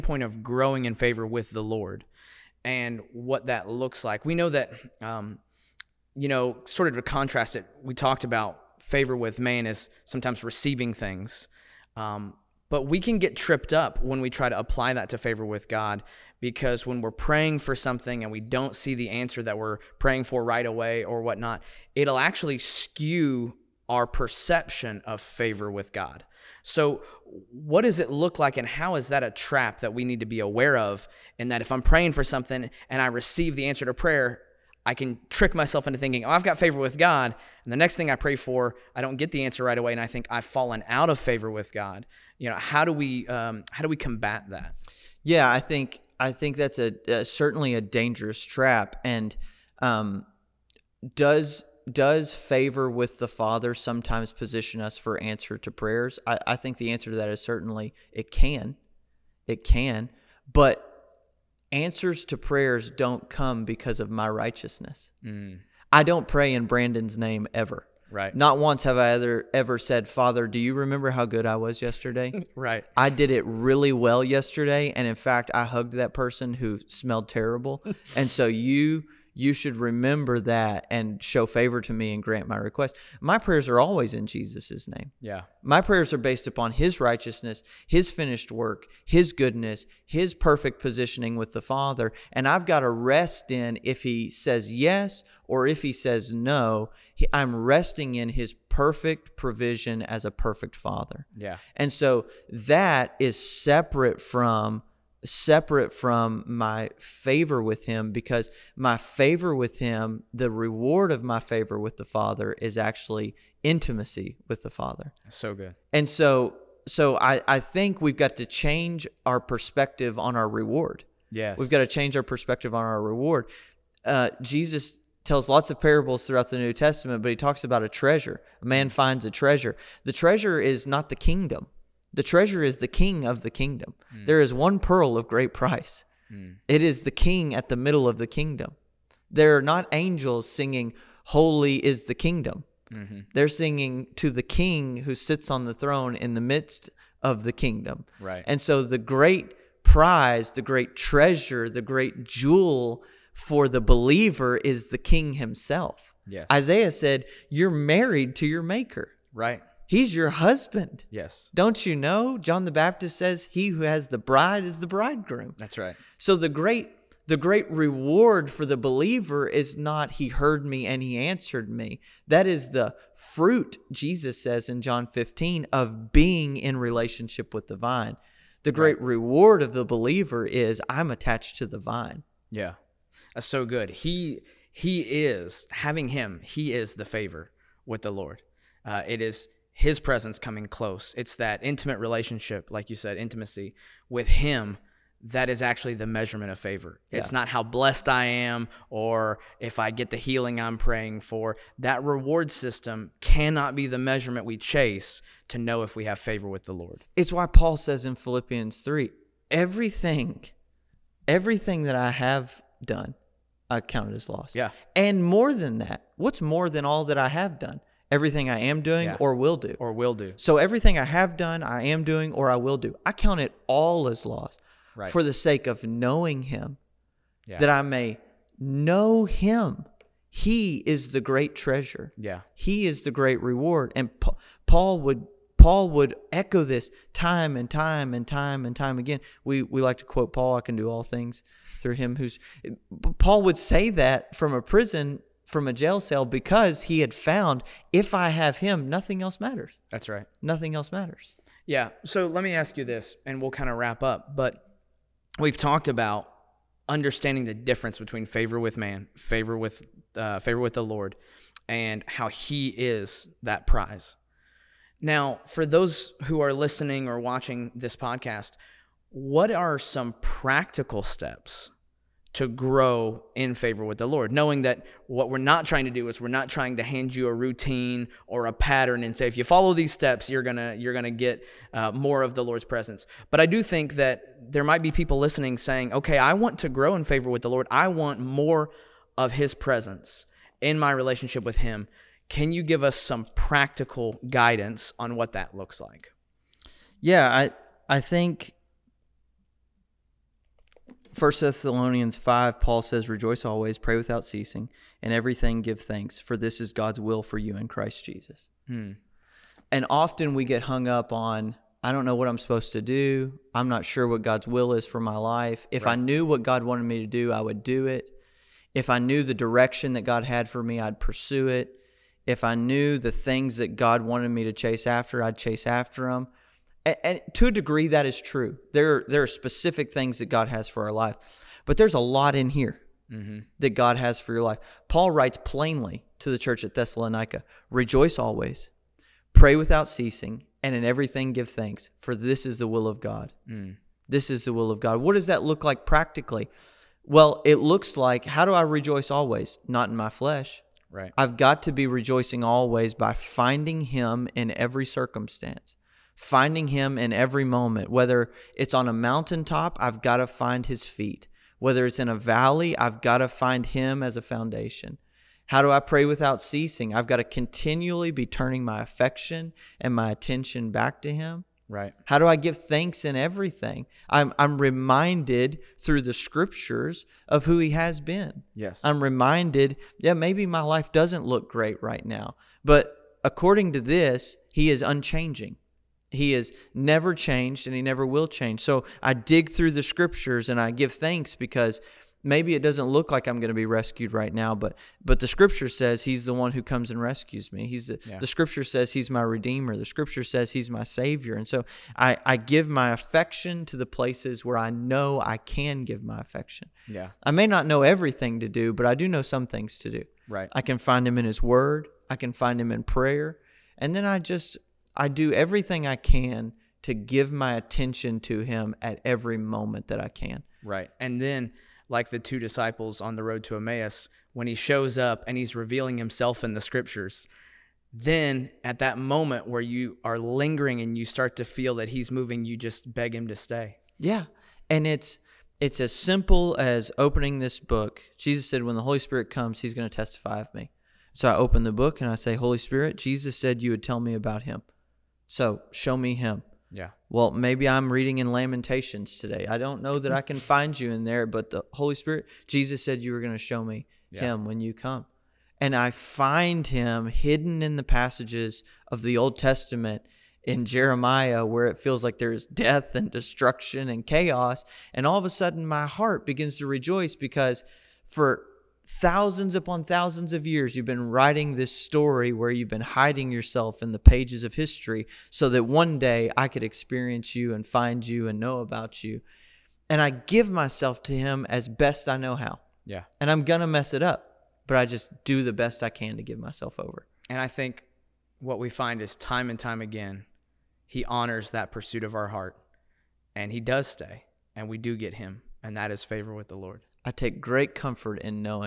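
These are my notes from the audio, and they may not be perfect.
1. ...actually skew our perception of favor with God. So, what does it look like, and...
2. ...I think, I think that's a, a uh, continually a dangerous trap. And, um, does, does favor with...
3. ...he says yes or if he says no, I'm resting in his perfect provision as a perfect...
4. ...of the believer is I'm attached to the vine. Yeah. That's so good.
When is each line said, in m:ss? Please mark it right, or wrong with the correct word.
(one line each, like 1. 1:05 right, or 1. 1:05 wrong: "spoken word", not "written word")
1. 0:22 right
2. 0:45 wrong: "certainly", not "continually"
3. 1:34 right
4. 2:59 right.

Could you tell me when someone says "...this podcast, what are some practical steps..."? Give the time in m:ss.
4:27.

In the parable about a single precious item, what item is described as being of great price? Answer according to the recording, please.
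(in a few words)
one pearl.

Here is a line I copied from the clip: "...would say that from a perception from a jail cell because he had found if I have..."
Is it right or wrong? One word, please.
wrong.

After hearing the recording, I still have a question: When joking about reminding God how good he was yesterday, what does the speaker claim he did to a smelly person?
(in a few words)
hugged that person.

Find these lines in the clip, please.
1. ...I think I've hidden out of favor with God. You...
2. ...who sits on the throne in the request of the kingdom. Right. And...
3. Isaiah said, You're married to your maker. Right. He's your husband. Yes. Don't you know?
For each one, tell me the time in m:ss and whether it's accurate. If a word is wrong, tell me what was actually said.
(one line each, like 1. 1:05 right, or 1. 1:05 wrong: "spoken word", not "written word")
1. 0:39 wrong: "fallen", not "hidden"
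2. 2:25 wrong: "midst", not "request"
3. 2:36 right.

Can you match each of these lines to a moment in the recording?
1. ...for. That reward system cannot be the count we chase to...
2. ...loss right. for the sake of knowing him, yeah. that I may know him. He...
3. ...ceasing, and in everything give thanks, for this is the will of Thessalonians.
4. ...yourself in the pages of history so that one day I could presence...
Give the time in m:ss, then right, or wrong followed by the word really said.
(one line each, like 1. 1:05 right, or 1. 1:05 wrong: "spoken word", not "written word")
1. 3:21 wrong: "measurement", not "count"
2. 3:44 right
3. 5:39 wrong: "God", not "Thessalonians"
4. 7:53 wrong: "experience", not "presence".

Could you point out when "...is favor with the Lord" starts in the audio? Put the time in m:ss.
8:15.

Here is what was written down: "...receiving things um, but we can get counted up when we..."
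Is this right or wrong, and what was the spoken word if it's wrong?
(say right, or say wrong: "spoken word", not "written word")
wrong: "tripped", not "counted".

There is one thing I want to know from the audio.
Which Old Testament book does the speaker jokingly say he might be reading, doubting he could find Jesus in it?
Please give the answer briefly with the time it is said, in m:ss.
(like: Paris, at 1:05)
Lamentations, at 7:28.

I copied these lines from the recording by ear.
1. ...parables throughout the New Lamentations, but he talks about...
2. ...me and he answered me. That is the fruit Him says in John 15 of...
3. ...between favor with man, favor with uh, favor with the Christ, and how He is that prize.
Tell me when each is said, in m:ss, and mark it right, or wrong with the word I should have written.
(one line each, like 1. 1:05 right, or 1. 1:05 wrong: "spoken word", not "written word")
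1. 2:05 wrong: "Testament", not "Lamentations"
2. 2:50 wrong: "Jesus", not "Him"
3. 4:17 wrong: "Lord", not "Christ".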